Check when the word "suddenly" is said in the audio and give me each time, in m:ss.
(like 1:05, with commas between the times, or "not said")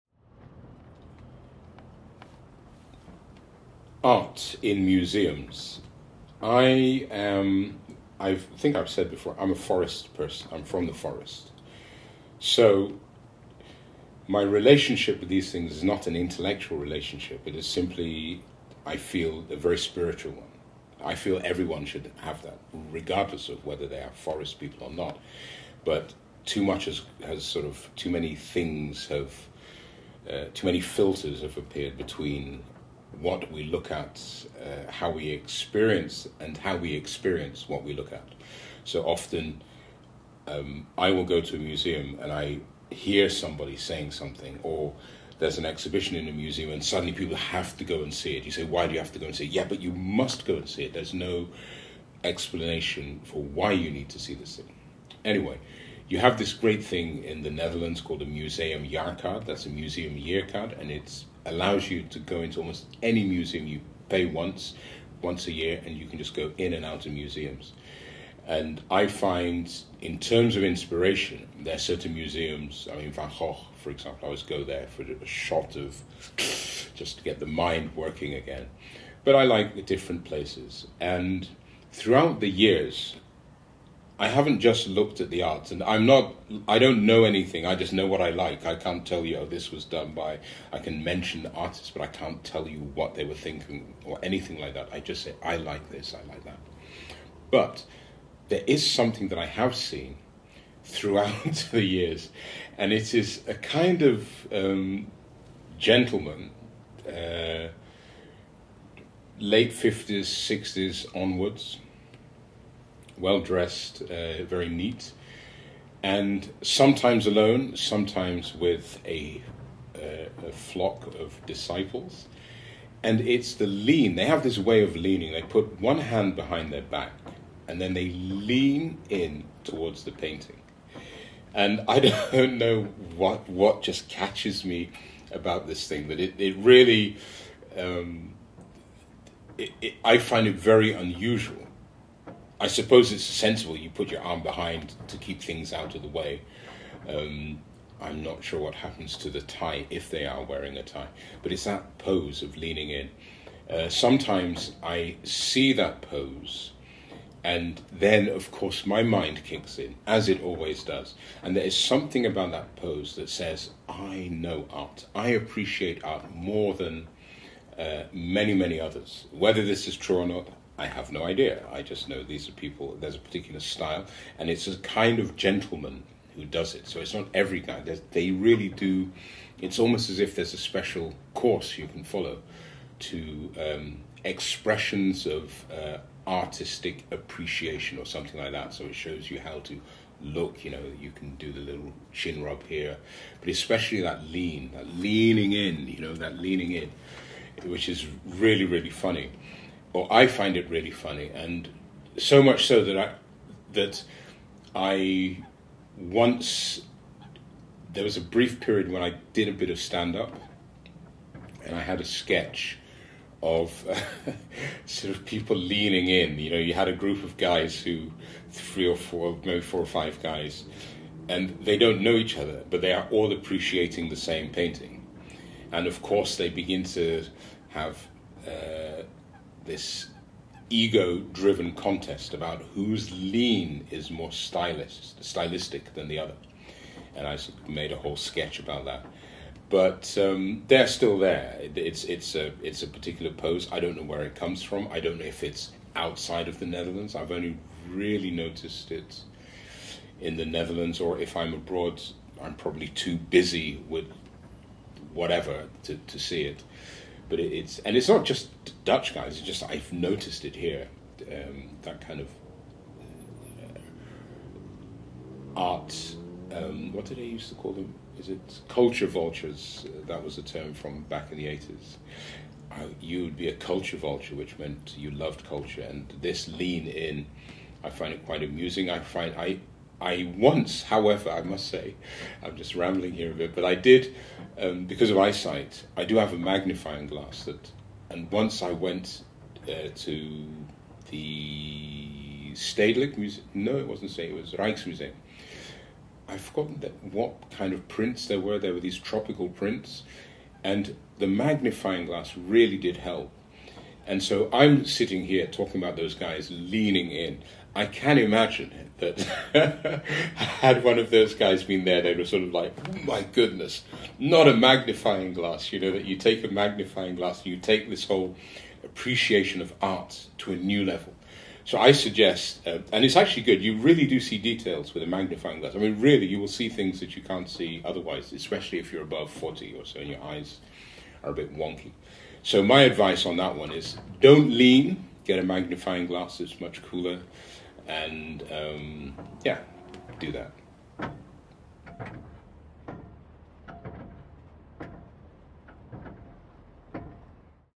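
0:46.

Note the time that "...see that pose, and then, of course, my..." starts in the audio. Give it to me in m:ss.
2:35.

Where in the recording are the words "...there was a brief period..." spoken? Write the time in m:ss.
3:27.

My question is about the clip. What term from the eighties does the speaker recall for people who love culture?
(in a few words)
culture vultures.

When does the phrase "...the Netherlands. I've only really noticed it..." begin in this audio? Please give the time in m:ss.
4:06.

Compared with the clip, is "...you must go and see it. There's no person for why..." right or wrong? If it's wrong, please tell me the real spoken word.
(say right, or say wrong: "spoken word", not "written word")
wrong: "explanation", not "person".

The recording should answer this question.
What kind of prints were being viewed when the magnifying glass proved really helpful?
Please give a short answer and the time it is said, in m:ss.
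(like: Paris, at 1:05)
tropical prints, at 4:58.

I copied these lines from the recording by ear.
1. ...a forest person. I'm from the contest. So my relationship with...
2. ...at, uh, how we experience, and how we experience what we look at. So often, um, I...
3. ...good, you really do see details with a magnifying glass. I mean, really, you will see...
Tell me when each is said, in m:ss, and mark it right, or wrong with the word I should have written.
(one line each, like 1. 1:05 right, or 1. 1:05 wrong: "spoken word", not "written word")
1. 0:09 wrong: "forest", not "contest"
2. 0:33 right
3. 5:23 right.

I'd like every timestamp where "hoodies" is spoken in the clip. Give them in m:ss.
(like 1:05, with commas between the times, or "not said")
not said.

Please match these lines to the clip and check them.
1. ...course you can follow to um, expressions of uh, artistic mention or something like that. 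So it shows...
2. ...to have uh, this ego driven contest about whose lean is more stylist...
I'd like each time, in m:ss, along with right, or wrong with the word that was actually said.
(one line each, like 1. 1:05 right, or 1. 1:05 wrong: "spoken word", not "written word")
1. 3:01 wrong: "appreciation", not "mention"
2. 3:46 right.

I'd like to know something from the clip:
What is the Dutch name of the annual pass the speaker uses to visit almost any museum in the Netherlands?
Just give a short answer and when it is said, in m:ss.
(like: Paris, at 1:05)
museum jaarkaart, at 0:58.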